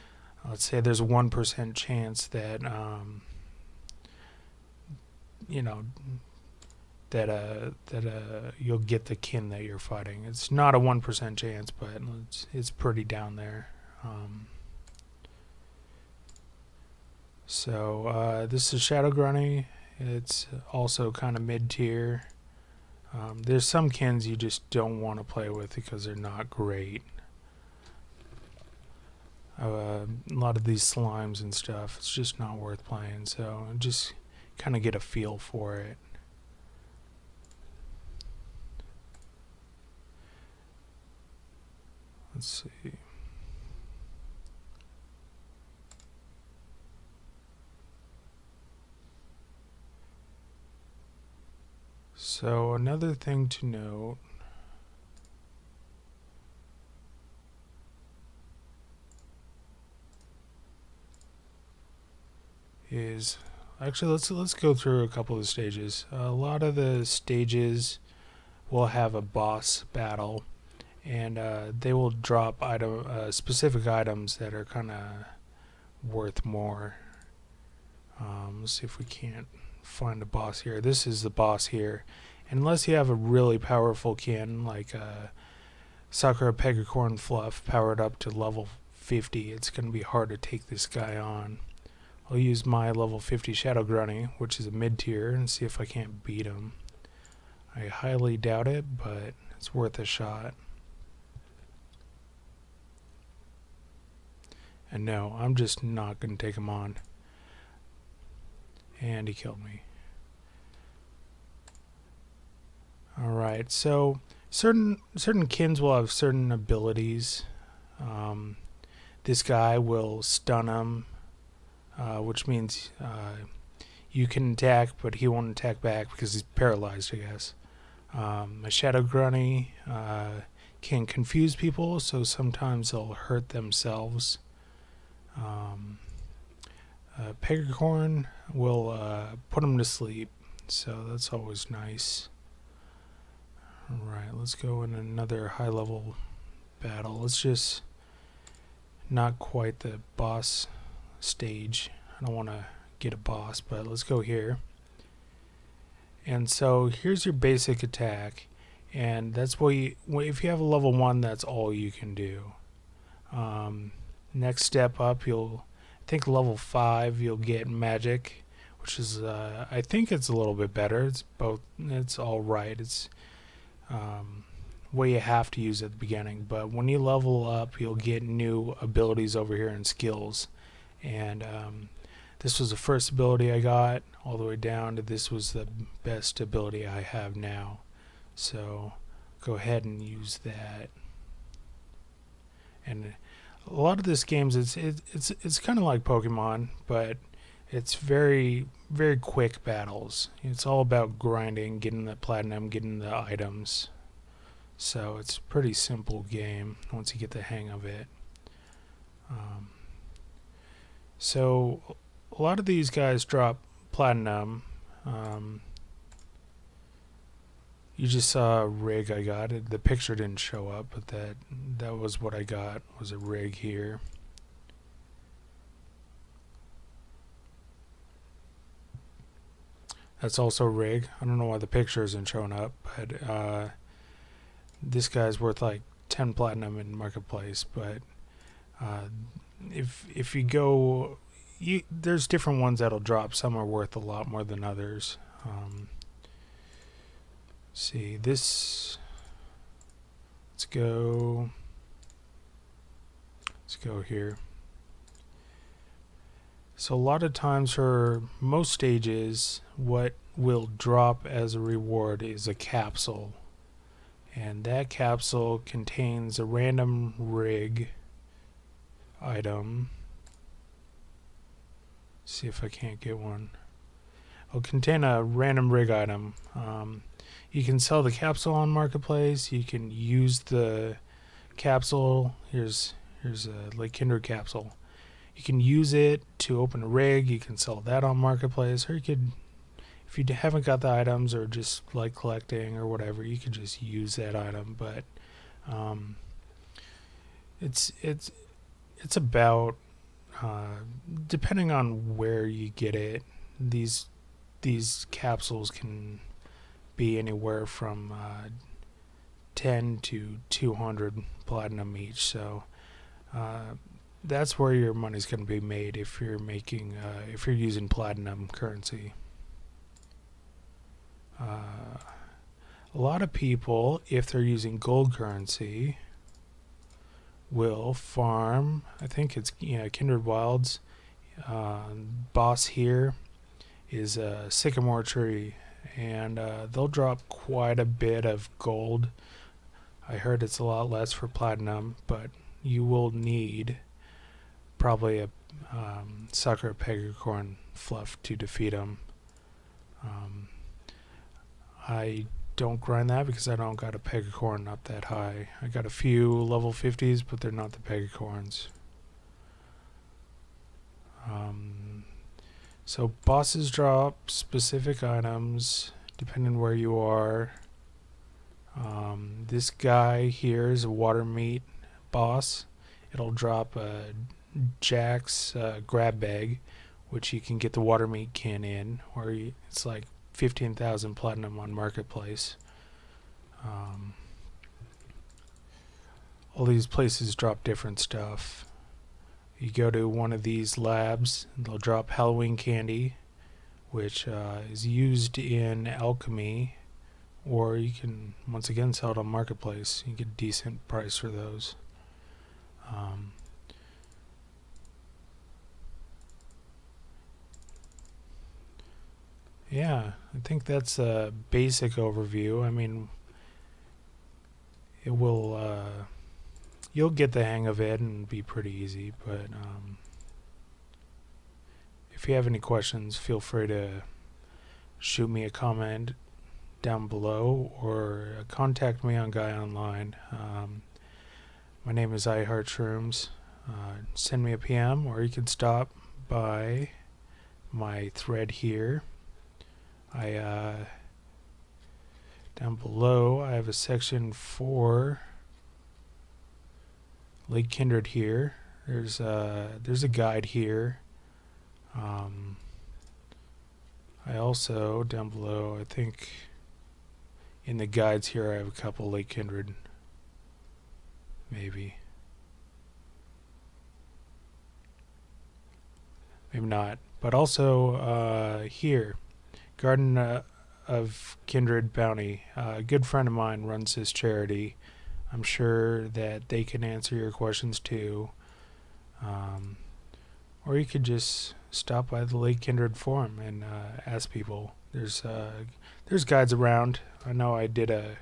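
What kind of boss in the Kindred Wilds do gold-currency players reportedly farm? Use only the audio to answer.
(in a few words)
Sycamore tree.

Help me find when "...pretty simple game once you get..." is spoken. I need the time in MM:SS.
03:25.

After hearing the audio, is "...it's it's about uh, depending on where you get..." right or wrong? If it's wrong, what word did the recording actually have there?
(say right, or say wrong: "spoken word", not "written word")
right.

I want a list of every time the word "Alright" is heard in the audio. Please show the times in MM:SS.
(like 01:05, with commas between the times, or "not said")
01:53, 02:23.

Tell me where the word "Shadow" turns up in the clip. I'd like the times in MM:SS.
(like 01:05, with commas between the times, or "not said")
00:18, 01:33, 02:08.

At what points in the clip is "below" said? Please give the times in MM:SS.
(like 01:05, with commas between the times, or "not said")
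07:07, 07:22, 07:35.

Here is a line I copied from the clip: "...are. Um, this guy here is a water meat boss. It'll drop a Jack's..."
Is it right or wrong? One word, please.
right.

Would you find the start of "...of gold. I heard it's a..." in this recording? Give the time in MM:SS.
05:38.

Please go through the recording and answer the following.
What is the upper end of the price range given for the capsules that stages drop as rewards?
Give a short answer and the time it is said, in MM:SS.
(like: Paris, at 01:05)
200 platinum, at 05:10.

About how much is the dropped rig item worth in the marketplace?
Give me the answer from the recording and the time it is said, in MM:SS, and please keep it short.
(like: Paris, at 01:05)
10 platinum, at 03:56.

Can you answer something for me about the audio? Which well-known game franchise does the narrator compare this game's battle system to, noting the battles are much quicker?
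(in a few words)
Pokemon.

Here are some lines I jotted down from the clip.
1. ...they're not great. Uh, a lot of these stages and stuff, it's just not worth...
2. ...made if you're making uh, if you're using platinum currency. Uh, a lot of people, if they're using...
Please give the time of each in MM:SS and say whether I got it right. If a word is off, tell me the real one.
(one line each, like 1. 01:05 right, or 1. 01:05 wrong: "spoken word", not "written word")
1. 00:26 wrong: "slimes", not "stages"
2. 05:15 right.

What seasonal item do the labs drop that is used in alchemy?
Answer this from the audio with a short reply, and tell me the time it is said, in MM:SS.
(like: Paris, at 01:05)
Halloween candy, at 06:32.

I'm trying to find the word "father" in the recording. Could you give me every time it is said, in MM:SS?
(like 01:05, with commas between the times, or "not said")
not said.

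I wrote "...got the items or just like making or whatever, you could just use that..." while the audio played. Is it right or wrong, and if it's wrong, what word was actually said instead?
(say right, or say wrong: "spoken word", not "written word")
wrong: "collecting", not "making".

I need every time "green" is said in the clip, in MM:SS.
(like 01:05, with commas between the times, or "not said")
not said.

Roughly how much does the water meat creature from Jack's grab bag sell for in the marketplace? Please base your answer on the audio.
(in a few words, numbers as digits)
15,000 platinum.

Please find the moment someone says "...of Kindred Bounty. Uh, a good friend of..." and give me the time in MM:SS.
07:50.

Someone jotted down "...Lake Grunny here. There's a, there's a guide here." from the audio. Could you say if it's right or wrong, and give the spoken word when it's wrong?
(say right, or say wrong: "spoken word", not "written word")
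wrong: "Kindred", not "Grunny".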